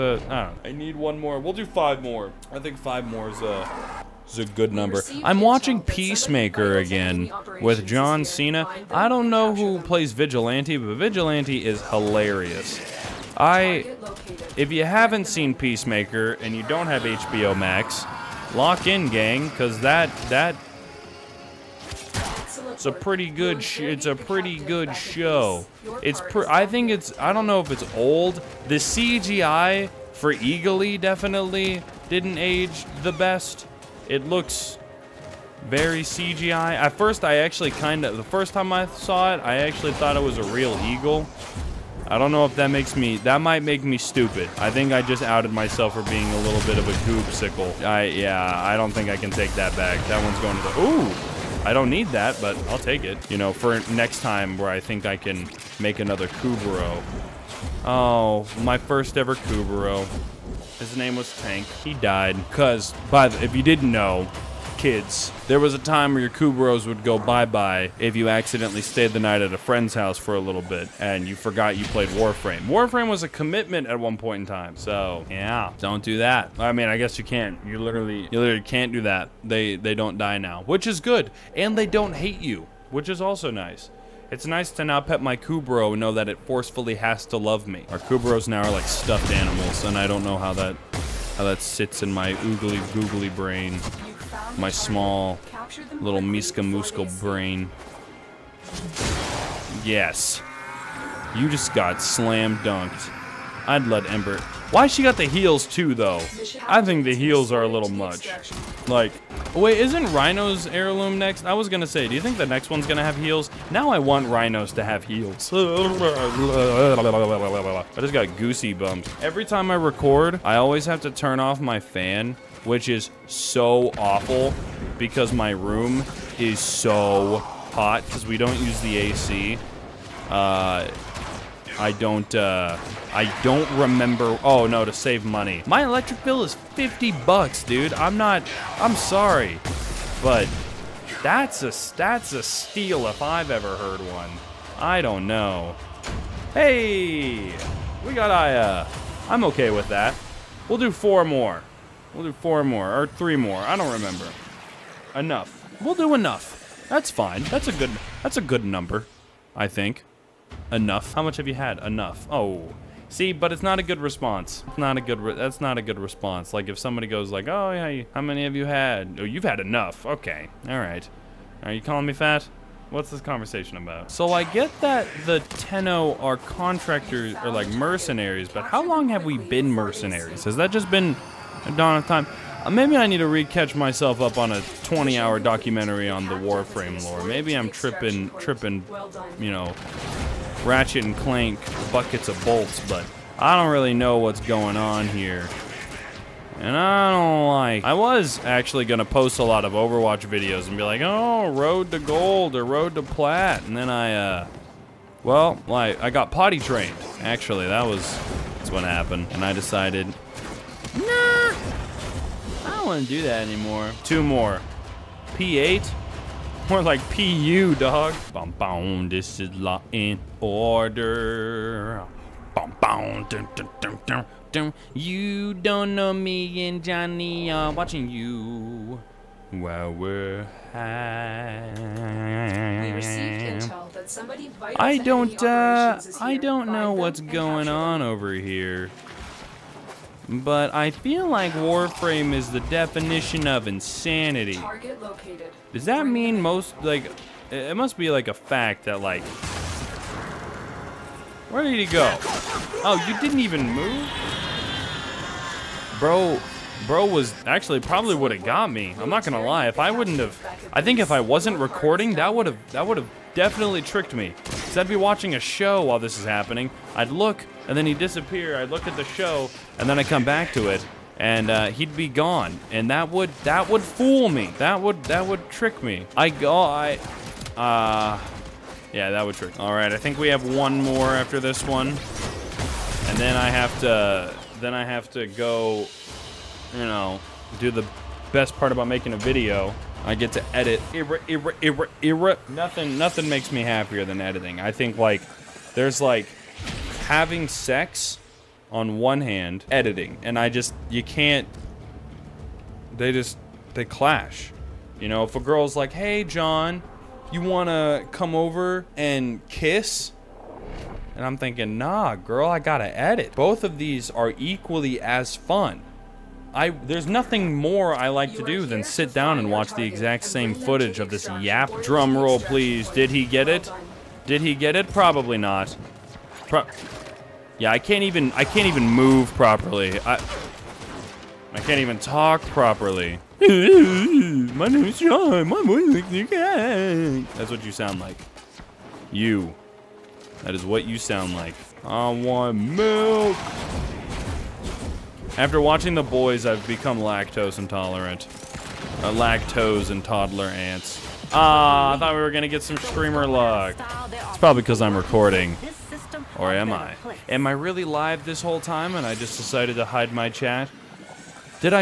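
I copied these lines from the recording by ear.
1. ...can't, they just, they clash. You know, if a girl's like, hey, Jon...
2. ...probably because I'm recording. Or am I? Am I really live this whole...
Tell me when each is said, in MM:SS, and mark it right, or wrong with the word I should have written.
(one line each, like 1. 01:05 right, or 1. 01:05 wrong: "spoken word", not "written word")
1. 05:01 right
2. 05:54 right.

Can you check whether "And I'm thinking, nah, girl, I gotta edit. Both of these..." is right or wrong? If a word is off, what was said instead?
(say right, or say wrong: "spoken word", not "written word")
right.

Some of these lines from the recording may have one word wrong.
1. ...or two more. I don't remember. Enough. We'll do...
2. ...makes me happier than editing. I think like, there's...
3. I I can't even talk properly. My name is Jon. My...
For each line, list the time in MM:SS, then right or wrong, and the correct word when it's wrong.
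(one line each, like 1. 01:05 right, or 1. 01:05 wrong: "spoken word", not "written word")
1. 02:32 wrong: "three", not "two"
2. 04:53 right
3. 05:30 right.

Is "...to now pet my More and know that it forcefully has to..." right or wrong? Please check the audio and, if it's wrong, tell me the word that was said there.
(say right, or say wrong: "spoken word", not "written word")
wrong: "Kubrow", not "More".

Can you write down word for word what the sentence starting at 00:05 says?
I'm watching Peacemaker again with John Cena.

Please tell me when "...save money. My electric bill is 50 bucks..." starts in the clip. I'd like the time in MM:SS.
02:14.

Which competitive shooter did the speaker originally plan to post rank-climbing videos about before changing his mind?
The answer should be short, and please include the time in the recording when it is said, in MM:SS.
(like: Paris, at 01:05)
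Overwatch, at 03:19.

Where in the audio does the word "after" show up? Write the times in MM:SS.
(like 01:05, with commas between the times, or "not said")
04:41, 05:45.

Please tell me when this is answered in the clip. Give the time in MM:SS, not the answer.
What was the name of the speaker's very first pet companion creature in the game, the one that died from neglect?
01:01.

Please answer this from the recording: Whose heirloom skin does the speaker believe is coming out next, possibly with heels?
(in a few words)
Rhino.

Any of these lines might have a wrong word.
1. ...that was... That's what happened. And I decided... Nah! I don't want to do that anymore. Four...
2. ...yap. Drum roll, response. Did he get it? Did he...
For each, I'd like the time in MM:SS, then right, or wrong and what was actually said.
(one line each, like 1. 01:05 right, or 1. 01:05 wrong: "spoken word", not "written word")
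1. 03:27 wrong: "Two", not "Four"
2. 05:21 wrong: "please", not "response".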